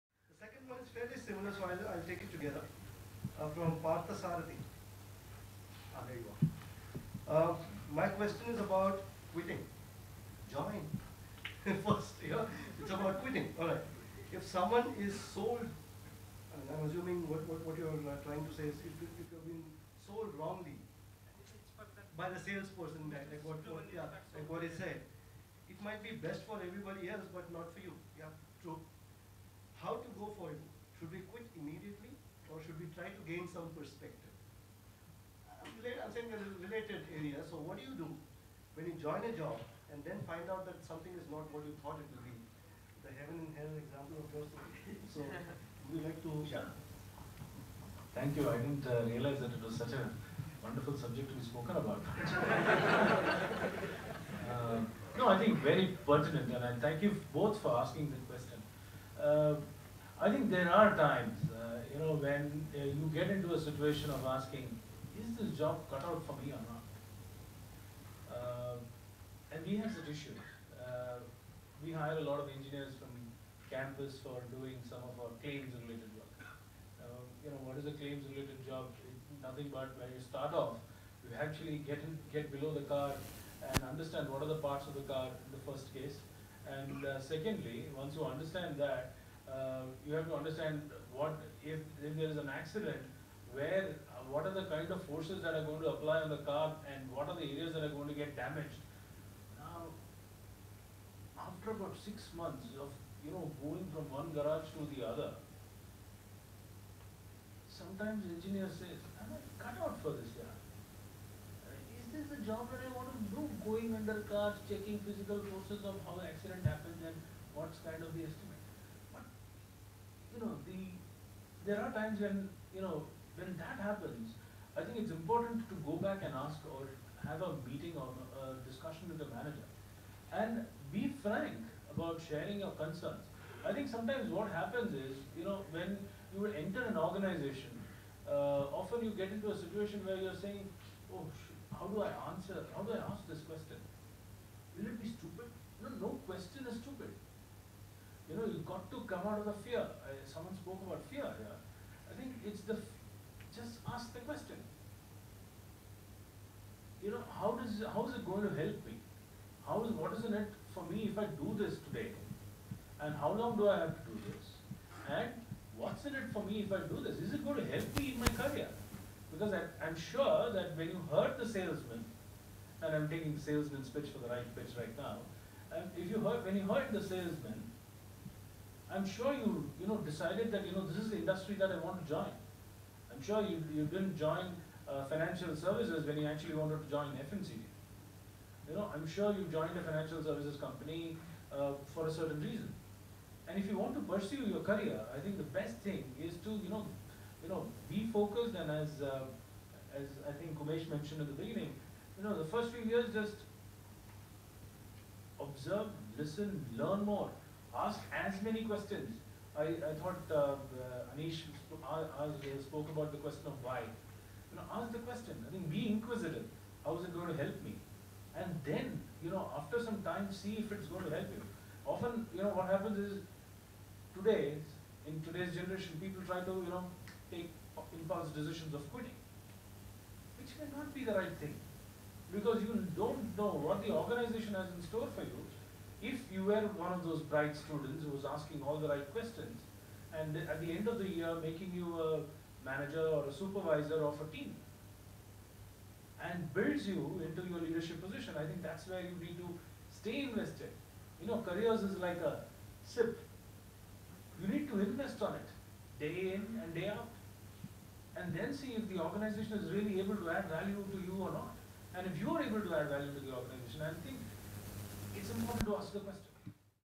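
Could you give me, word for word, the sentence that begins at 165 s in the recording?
And what's in it for me if I do this?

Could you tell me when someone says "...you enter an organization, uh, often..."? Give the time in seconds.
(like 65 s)
136 s.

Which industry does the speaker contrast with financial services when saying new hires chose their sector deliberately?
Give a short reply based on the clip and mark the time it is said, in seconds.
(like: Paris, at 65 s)
FMCG, at 187 s.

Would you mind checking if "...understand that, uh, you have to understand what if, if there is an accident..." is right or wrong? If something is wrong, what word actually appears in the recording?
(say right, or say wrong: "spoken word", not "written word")
right.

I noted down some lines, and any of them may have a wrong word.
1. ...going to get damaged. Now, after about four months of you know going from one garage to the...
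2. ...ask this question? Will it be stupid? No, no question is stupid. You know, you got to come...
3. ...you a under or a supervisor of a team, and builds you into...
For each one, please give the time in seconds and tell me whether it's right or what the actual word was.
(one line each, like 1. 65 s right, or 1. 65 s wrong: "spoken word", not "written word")
1. 97 s wrong: "six", not "four"
2. 143 s right
3. 241 s wrong: "manager", not "under".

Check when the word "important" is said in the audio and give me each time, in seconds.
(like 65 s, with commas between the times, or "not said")
125 s, 265 s.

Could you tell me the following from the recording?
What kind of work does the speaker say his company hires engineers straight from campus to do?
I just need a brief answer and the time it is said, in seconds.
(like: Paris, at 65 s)
Claims-related work, at 75 s.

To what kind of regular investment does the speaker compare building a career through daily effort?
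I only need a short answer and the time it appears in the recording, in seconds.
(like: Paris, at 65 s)
A SIP, at 252 s.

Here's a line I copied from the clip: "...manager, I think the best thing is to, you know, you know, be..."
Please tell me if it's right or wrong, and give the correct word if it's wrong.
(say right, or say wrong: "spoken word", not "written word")
wrong: "career", not "manager".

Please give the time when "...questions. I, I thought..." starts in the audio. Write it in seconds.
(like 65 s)
208 s.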